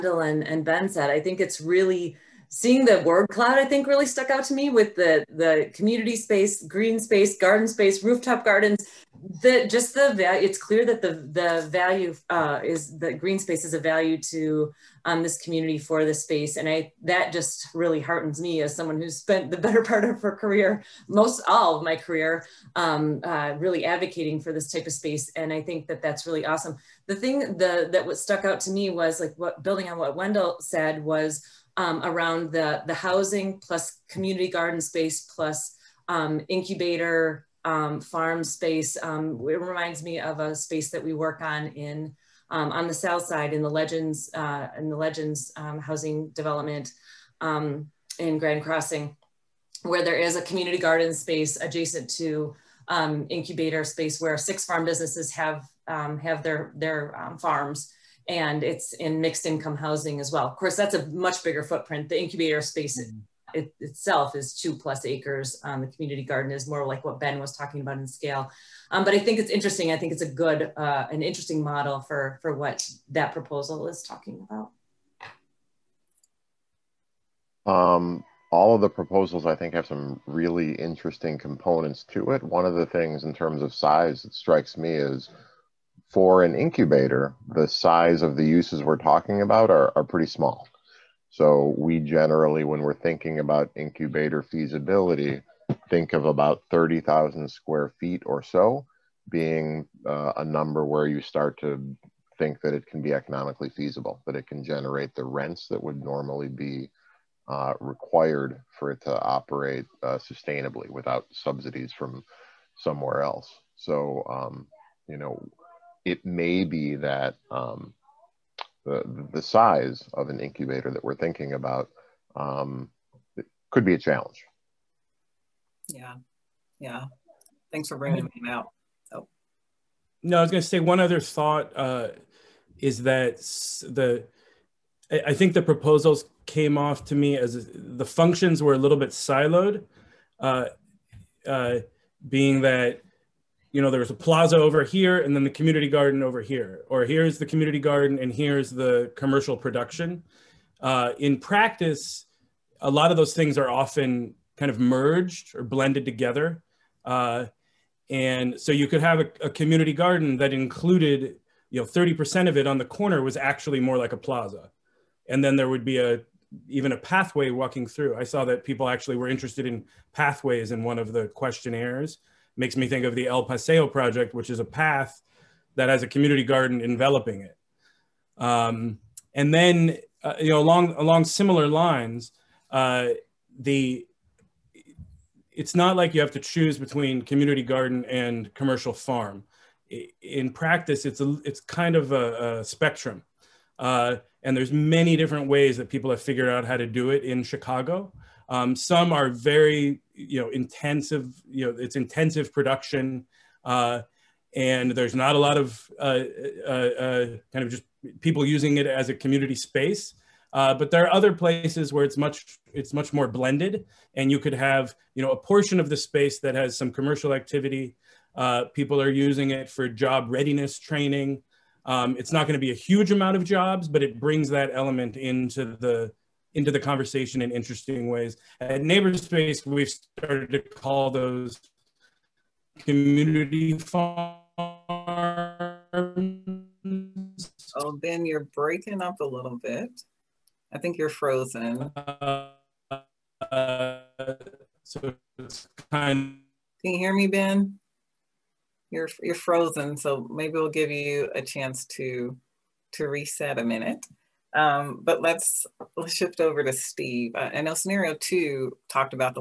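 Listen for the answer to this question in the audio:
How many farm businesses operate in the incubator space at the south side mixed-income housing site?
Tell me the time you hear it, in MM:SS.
00:54.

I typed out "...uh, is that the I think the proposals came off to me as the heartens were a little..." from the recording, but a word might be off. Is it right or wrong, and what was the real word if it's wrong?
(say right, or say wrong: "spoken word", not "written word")
wrong: "functions", not "heartens".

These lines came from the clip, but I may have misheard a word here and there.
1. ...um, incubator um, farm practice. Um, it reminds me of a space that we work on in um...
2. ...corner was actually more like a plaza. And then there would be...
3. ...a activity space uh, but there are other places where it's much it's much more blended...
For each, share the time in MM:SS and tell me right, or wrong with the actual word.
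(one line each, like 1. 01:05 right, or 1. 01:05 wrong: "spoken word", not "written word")
1. 00:36 wrong: "space", not "practice"
2. 02:42 right
3. 03:29 wrong: "community", not "activity".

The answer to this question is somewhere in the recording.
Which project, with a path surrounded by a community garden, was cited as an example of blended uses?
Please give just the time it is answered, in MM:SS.
02:53.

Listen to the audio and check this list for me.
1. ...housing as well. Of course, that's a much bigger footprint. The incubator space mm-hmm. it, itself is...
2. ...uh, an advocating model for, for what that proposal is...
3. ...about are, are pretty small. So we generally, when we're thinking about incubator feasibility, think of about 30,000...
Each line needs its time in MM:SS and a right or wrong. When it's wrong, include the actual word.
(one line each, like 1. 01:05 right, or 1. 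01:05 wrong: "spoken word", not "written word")
1. 00:59 right
2. 01:10 wrong: "interesting", not "advocating"
3. 01:29 right.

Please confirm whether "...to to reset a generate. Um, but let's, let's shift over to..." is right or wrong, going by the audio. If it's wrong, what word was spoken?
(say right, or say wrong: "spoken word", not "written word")
wrong: "minute", not "generate".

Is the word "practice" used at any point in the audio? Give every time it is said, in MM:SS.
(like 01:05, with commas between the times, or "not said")
02:31, 03:10.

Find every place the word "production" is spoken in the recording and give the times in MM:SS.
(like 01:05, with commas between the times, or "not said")
02:29, 03:22.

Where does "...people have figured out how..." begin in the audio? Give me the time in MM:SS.
03:15.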